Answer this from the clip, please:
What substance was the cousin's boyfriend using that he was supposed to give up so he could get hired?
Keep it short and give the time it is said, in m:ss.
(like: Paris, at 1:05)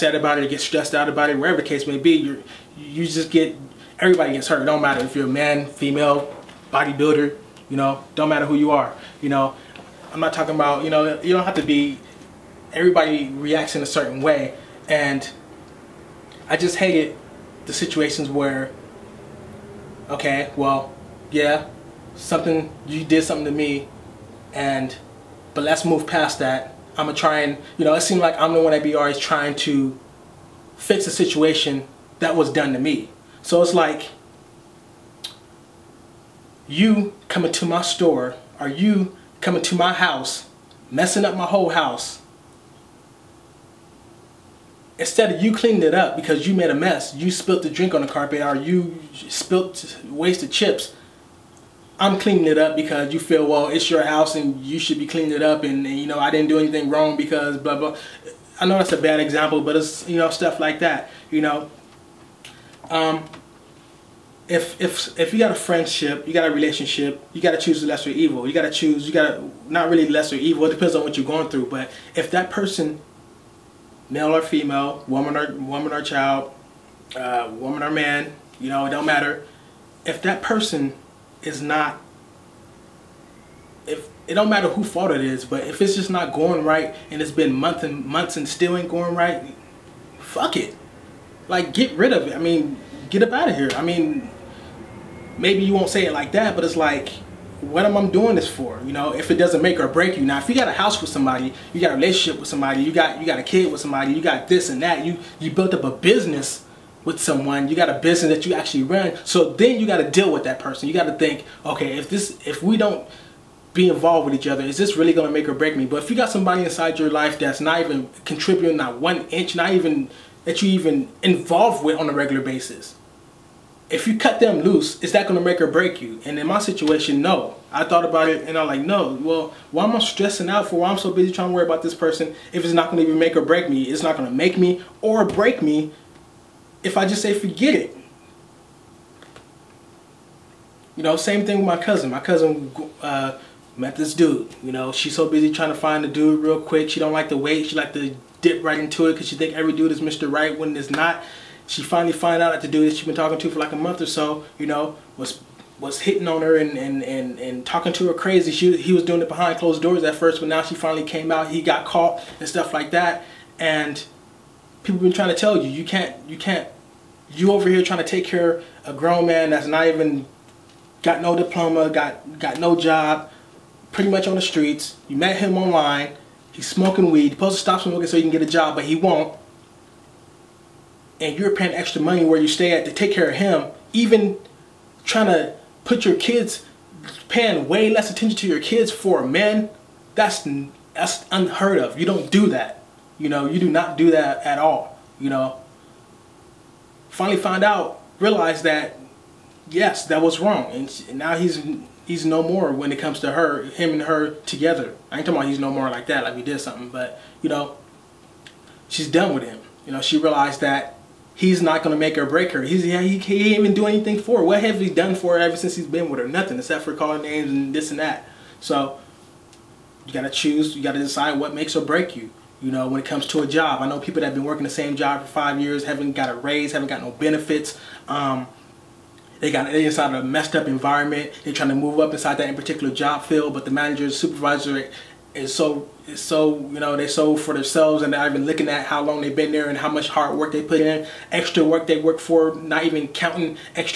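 weed, at 2:57.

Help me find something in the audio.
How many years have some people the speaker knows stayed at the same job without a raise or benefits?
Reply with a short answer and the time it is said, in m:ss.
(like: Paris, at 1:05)
5, at 3:45.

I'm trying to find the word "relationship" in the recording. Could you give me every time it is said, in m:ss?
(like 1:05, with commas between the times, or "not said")
1:06, 1:41.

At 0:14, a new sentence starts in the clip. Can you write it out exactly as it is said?
And I just hated the situations where, okay, well, yeah, something, you did something to me and but let's move past that.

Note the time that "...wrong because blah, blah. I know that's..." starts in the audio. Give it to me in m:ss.
0:56.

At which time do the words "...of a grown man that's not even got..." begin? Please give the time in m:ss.
2:48.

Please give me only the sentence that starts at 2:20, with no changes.
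You know, same thing with my cousin.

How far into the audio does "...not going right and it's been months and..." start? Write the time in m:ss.
1:26.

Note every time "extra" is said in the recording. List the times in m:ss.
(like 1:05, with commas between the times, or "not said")
3:01, 4:01.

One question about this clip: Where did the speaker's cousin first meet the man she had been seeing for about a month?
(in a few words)
online.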